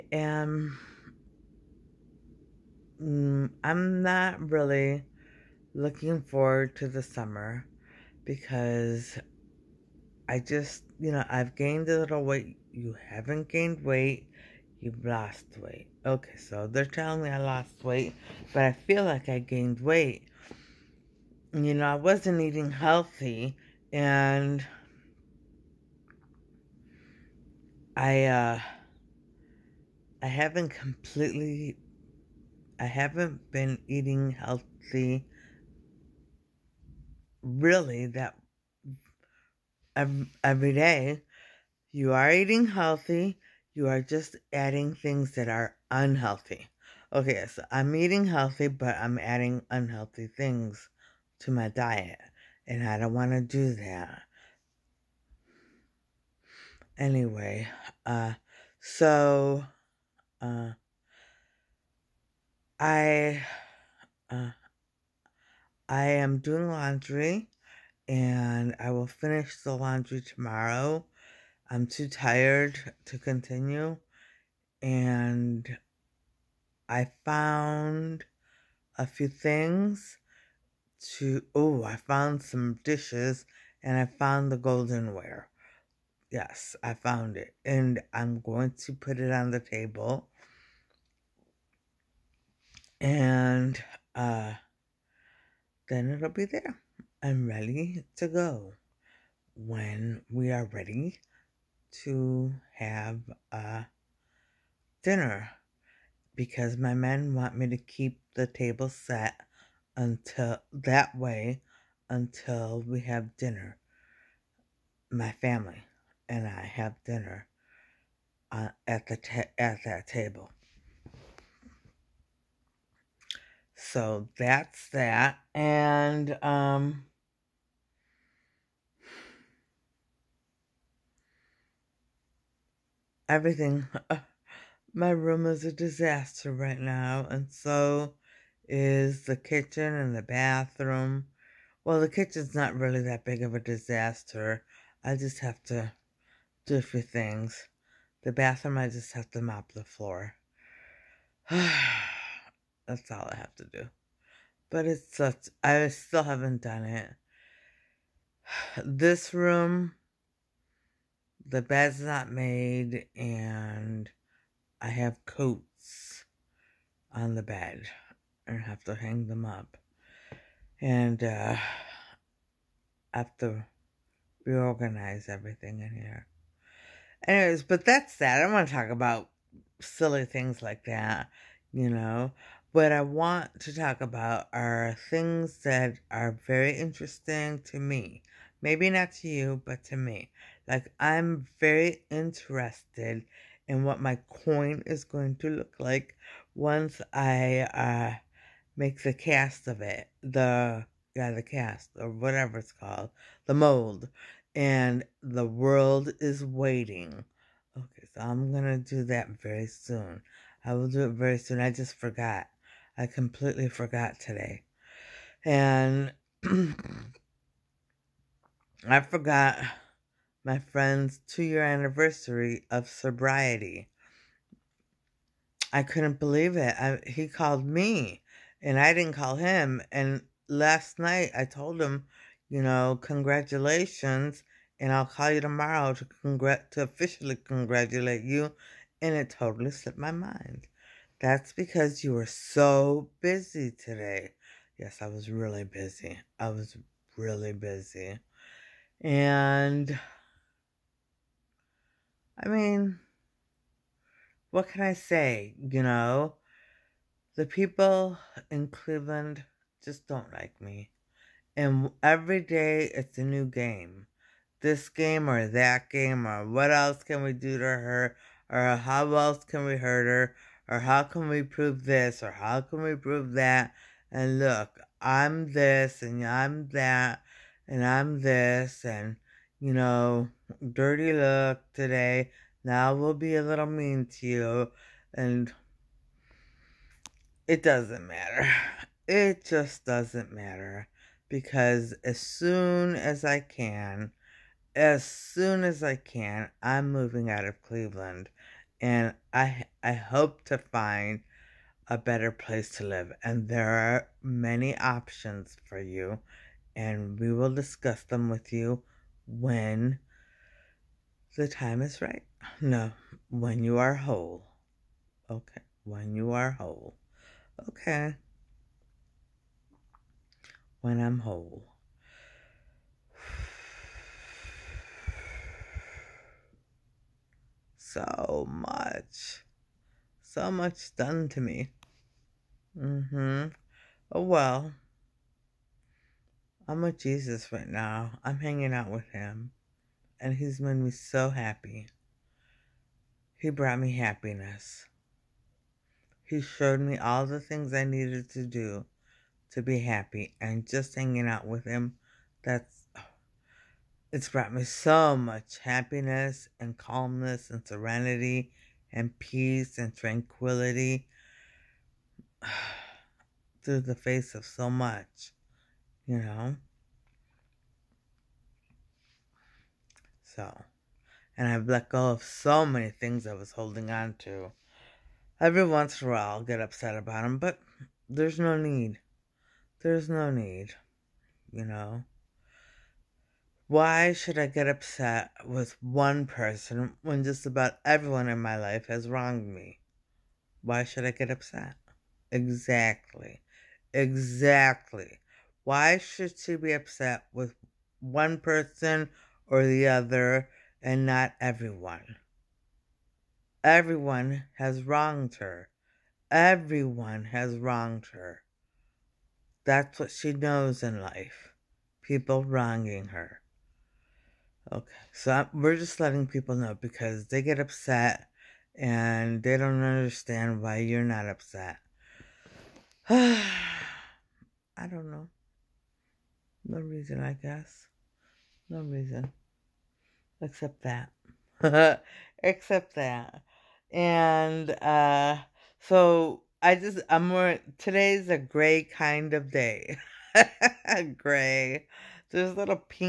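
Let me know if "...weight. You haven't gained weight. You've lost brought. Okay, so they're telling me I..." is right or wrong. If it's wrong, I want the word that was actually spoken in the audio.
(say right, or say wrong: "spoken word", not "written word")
wrong: "weight", not "brought".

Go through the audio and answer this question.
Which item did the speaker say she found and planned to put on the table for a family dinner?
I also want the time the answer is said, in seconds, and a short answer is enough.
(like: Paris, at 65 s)
goldenware, at 84 s.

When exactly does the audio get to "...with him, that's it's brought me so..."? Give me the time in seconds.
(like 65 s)
351 s.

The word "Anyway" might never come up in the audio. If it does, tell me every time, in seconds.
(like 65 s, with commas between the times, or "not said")
56 s, 177 s.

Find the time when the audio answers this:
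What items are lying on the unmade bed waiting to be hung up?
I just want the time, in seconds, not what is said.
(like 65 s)
165 s.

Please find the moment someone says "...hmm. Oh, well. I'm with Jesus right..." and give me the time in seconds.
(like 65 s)
333 s.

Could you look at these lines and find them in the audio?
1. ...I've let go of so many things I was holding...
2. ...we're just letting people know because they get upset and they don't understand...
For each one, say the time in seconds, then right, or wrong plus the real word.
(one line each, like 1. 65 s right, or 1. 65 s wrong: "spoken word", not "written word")
1. 371 s right
2. 415 s right.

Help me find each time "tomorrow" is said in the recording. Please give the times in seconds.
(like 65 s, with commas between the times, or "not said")
70 s, 235 s.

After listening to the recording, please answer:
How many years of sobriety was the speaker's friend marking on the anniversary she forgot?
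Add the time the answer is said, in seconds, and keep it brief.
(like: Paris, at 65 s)
2, at 221 s.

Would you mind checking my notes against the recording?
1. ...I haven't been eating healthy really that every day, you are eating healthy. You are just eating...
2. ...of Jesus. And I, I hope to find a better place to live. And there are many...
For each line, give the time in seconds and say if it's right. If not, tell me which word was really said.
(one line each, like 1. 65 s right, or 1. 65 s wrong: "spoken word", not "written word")
1. 32 s wrong: "adding", not "eating"
2. 297 s wrong: "Cleveland", not "Jesus".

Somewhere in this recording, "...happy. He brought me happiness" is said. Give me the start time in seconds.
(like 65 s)
341 s.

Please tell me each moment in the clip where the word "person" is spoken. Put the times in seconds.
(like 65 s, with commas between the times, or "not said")
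386 s, 398 s.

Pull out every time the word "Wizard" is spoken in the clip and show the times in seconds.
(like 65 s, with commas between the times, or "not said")
not said.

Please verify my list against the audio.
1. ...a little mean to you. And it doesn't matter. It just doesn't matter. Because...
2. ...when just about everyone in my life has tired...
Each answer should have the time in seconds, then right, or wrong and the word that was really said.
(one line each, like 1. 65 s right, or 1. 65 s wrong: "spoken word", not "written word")
1. 283 s right
2. 387 s wrong: "wronged", not "tired".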